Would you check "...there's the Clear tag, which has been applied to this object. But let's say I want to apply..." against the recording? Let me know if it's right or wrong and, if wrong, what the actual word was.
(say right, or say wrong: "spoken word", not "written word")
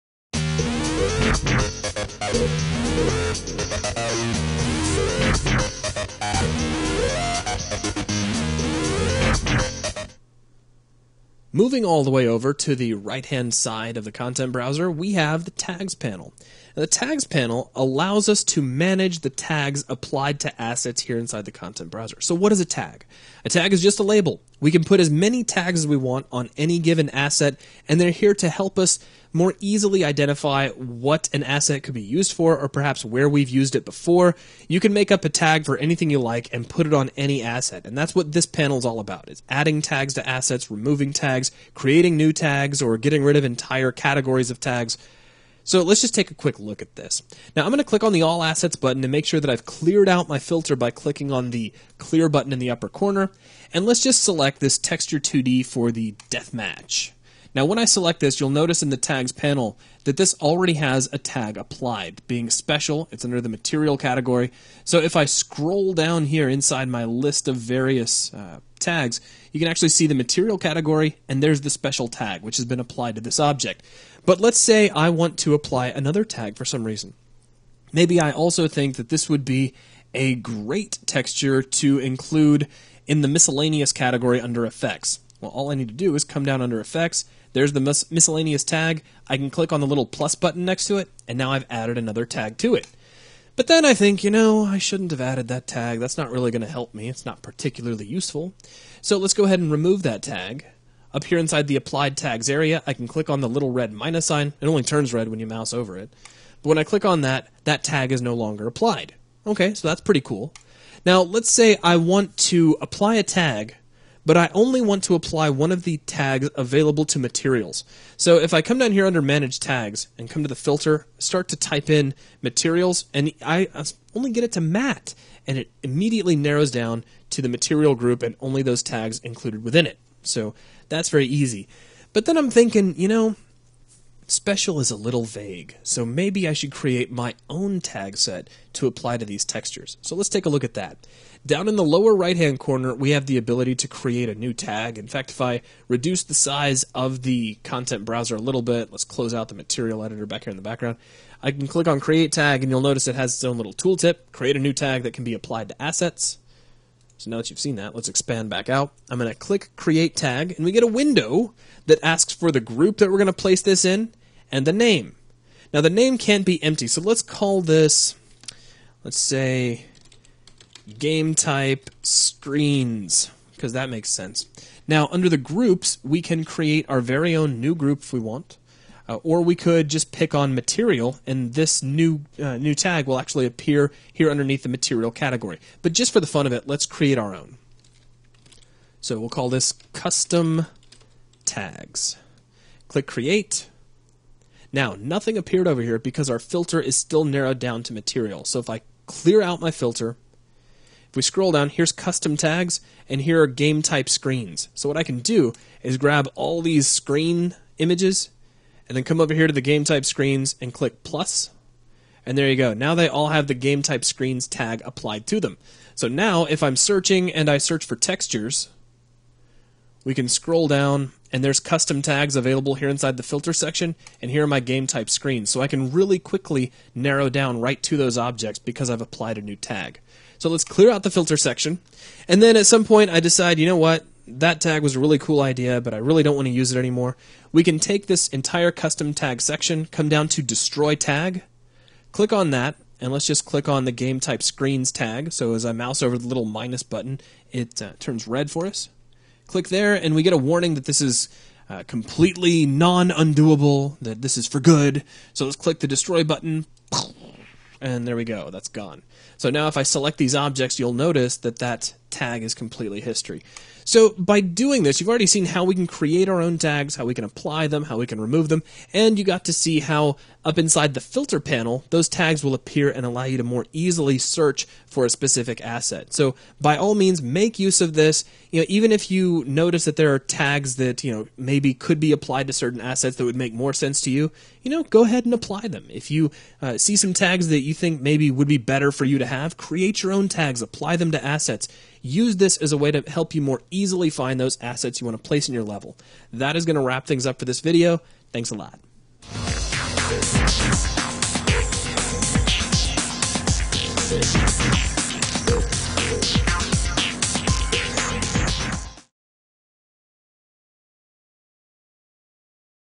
wrong: "Special", not "Clear".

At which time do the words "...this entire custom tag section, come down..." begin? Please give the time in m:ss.
3:58.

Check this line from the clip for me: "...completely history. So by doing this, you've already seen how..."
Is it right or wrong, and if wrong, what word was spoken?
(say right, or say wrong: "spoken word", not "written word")
right.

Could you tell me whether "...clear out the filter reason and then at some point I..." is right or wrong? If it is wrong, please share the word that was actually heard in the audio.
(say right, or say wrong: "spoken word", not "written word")
wrong: "section", not "reason".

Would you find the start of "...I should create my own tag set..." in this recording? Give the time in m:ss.
2:16.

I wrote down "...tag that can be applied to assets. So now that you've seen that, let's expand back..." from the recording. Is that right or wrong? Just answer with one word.
right.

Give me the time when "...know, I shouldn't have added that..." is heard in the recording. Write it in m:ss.
1:34.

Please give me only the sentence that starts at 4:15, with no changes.
So let's click the destroy button, and there we go, that's gone.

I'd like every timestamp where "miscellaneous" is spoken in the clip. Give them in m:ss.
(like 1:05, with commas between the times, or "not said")
1:23, 1:28.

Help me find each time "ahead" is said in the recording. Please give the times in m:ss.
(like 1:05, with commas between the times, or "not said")
1:39, 4:45.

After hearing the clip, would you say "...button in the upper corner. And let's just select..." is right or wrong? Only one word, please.
right.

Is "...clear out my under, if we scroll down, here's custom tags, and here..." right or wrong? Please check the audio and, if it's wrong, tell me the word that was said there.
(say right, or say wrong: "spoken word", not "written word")
wrong: "filter", not "under".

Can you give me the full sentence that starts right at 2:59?
Uh, or we could just pick on material, and this new uh, new tag will actually appear here underneath the material category.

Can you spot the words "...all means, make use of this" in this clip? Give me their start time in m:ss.
4:36.